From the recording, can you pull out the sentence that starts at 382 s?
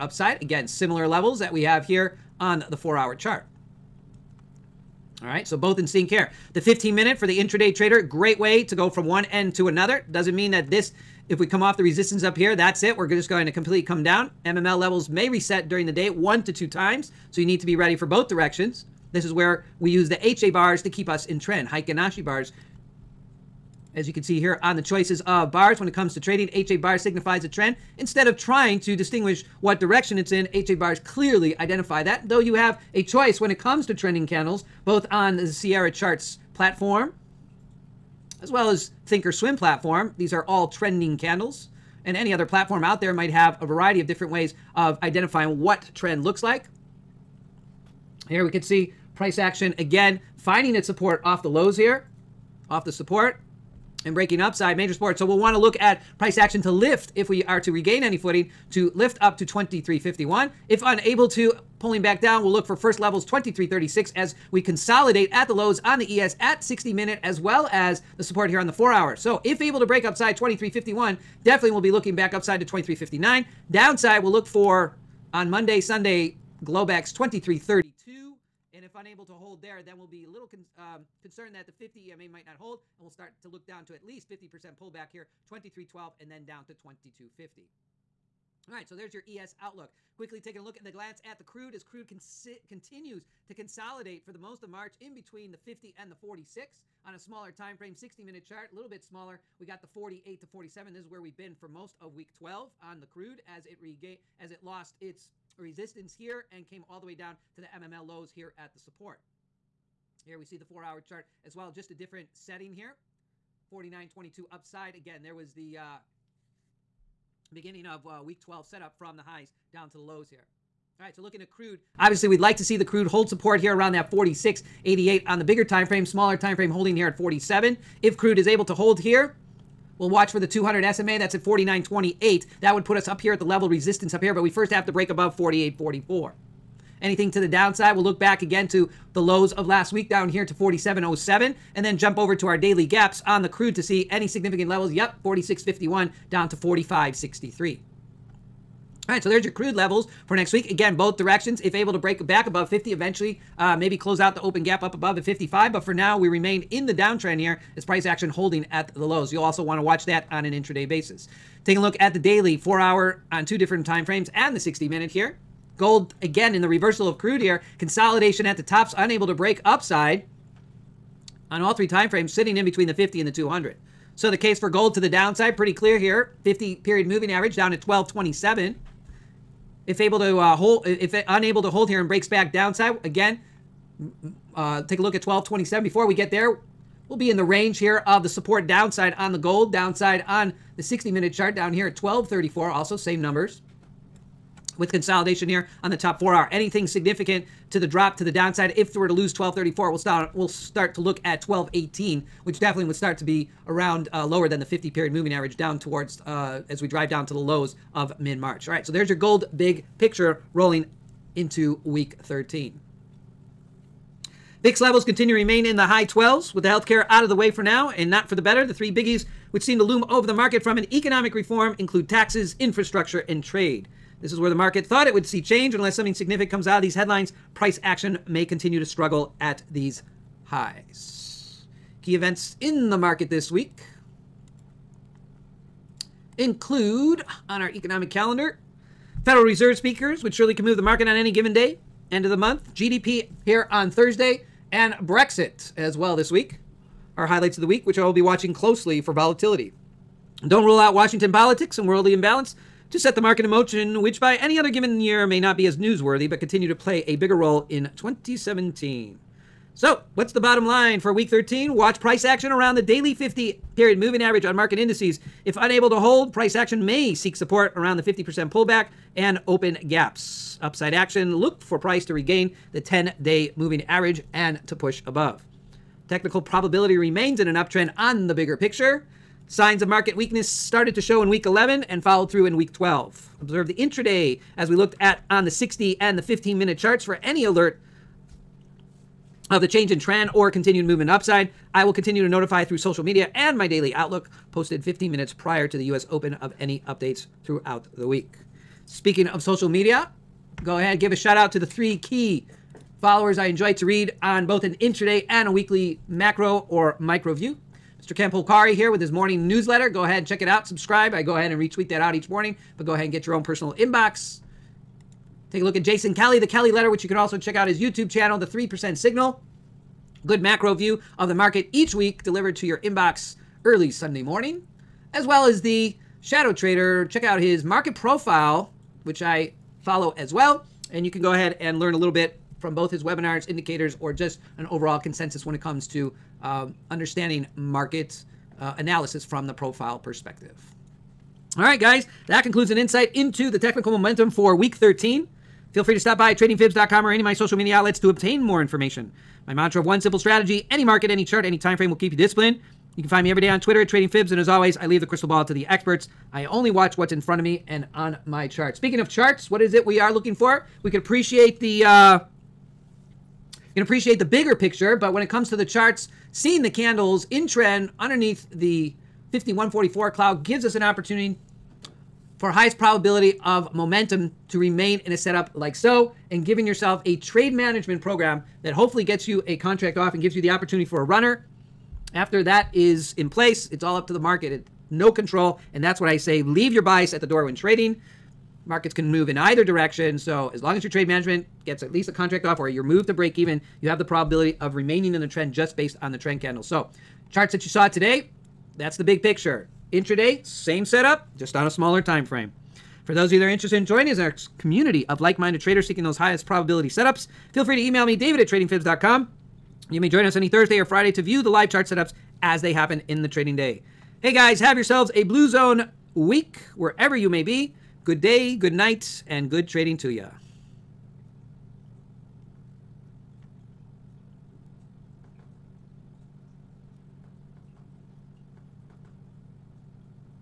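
After that is in place, it's all up to the market.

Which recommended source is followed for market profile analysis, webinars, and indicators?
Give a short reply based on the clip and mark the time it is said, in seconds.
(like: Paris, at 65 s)
Shadow Trader, at 326 s.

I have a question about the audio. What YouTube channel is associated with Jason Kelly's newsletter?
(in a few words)
The 3% Signal.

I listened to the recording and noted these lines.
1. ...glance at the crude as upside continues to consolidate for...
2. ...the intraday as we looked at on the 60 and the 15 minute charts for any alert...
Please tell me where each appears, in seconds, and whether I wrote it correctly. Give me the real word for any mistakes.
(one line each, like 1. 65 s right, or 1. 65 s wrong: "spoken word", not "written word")
1. 90 s wrong: "crude", not "upside"
2. 283 s right.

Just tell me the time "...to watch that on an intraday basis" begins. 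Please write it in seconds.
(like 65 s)
159 s.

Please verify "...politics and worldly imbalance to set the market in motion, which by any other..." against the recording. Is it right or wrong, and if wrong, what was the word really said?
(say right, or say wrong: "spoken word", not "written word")
right.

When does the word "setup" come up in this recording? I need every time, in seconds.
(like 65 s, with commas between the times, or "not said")
118 s, 375 s, 400 s, 406 s, 411 s.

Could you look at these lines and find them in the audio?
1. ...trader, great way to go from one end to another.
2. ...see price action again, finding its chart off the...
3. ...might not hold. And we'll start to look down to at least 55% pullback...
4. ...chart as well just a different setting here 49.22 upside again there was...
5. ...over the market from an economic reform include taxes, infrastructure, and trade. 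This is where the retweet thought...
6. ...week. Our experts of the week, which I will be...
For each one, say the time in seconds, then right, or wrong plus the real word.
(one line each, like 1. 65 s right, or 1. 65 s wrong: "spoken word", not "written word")
1. 7 s right
2. 48 s wrong: "support", not "chart"
3. 82 s wrong: "50", not "55"
4. 110 s right
5. 220 s wrong: "market", not "retweet"
6. 246 s wrong: "highlights", not "experts".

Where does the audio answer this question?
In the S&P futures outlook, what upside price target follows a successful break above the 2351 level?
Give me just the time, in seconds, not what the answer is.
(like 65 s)
72 s.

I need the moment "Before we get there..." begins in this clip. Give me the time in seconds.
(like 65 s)
185 s.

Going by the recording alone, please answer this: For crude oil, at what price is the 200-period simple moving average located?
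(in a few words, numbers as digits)
49.28.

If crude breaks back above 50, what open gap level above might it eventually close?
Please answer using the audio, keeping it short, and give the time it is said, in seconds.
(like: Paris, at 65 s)
55, at 155 s.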